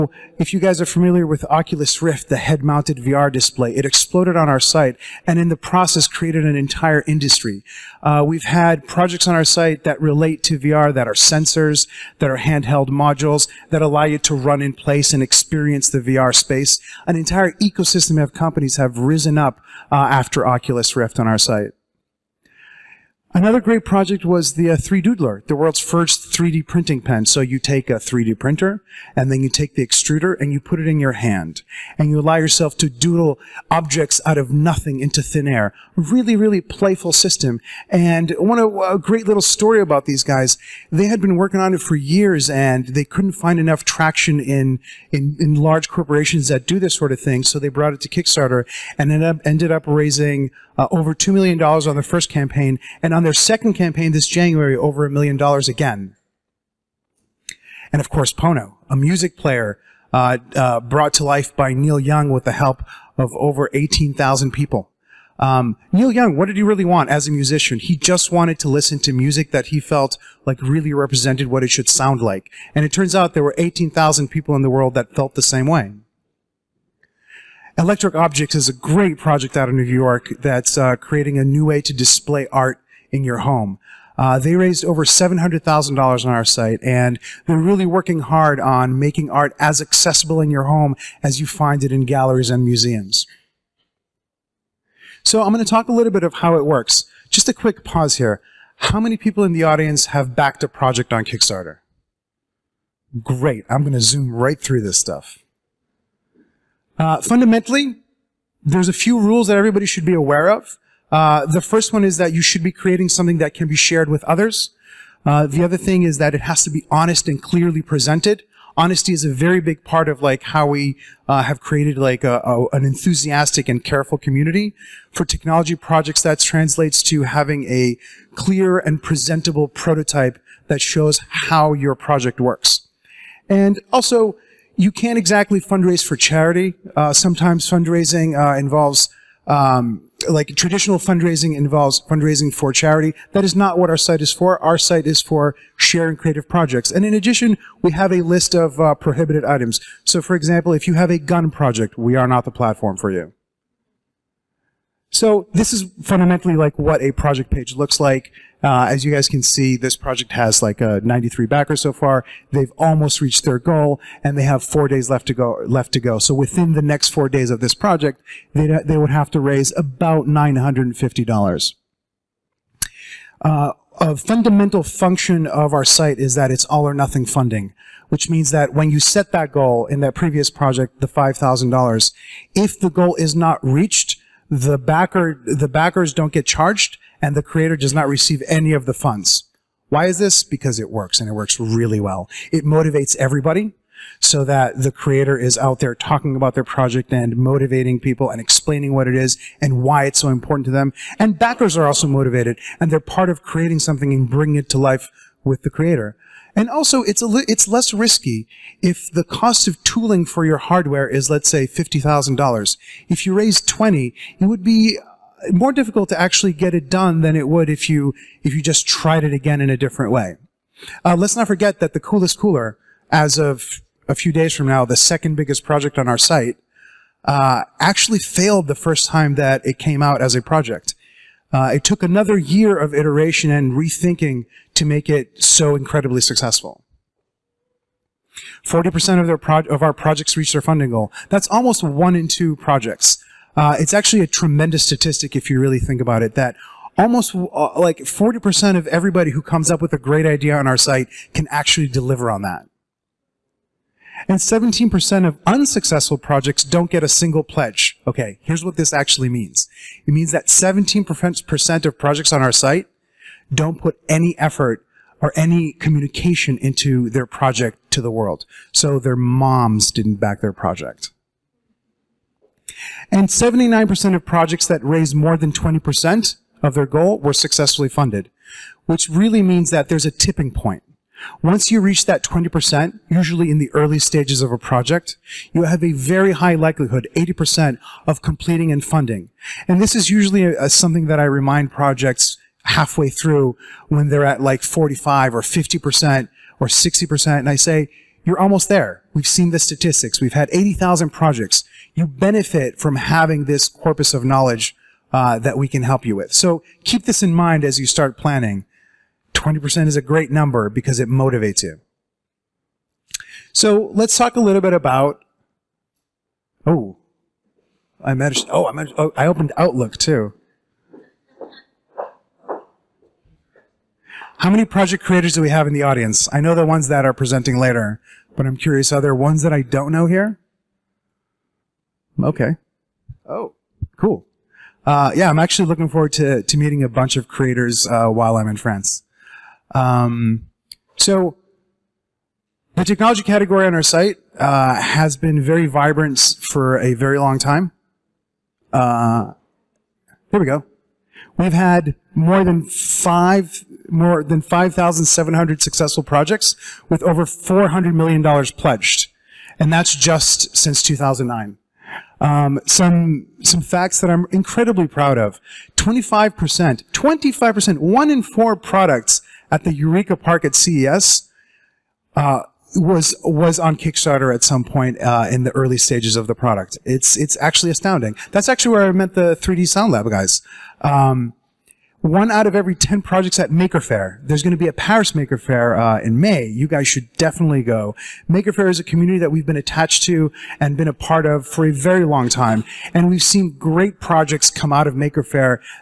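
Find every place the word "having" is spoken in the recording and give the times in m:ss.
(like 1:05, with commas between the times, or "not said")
2:07, 5:02.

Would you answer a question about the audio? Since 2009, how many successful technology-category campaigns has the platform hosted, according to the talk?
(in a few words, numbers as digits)
more than 5,700.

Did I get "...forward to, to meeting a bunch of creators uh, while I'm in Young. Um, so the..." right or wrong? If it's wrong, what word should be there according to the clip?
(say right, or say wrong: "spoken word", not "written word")
wrong: "France", not "Young".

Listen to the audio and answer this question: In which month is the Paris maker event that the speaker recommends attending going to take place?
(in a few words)
May.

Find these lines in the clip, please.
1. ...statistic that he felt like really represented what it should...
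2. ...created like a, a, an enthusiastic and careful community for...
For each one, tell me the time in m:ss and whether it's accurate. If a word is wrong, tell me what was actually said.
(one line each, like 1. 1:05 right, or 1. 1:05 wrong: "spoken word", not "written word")
1. 1:09 wrong: "music", not "statistic"
2. 2:01 right.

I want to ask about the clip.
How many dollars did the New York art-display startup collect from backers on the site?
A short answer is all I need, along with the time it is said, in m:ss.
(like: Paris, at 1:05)
over $700,000, at 1:24.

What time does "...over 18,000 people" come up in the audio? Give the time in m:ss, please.
1:03.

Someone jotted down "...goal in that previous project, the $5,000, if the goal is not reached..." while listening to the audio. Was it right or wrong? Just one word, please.
right.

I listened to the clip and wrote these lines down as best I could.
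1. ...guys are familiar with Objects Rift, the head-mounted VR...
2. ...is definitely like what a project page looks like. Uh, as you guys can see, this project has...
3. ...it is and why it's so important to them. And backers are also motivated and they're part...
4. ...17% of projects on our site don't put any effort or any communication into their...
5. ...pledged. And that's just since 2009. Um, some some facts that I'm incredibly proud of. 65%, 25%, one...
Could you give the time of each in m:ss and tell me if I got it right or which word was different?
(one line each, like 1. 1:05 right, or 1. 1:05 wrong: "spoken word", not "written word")
1. 0:00 wrong: "Oculus", not "Objects"
2. 2:35 wrong: "fundamentally", not "definitely"
3. 3:19 right
4. 4:20 right
5. 5:58 wrong: "25", not "65".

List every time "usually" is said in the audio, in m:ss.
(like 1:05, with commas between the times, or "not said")
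4:43, 4:50.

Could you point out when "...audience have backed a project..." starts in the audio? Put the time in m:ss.
1:39.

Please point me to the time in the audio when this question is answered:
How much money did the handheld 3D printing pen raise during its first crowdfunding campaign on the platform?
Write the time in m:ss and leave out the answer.
0:50.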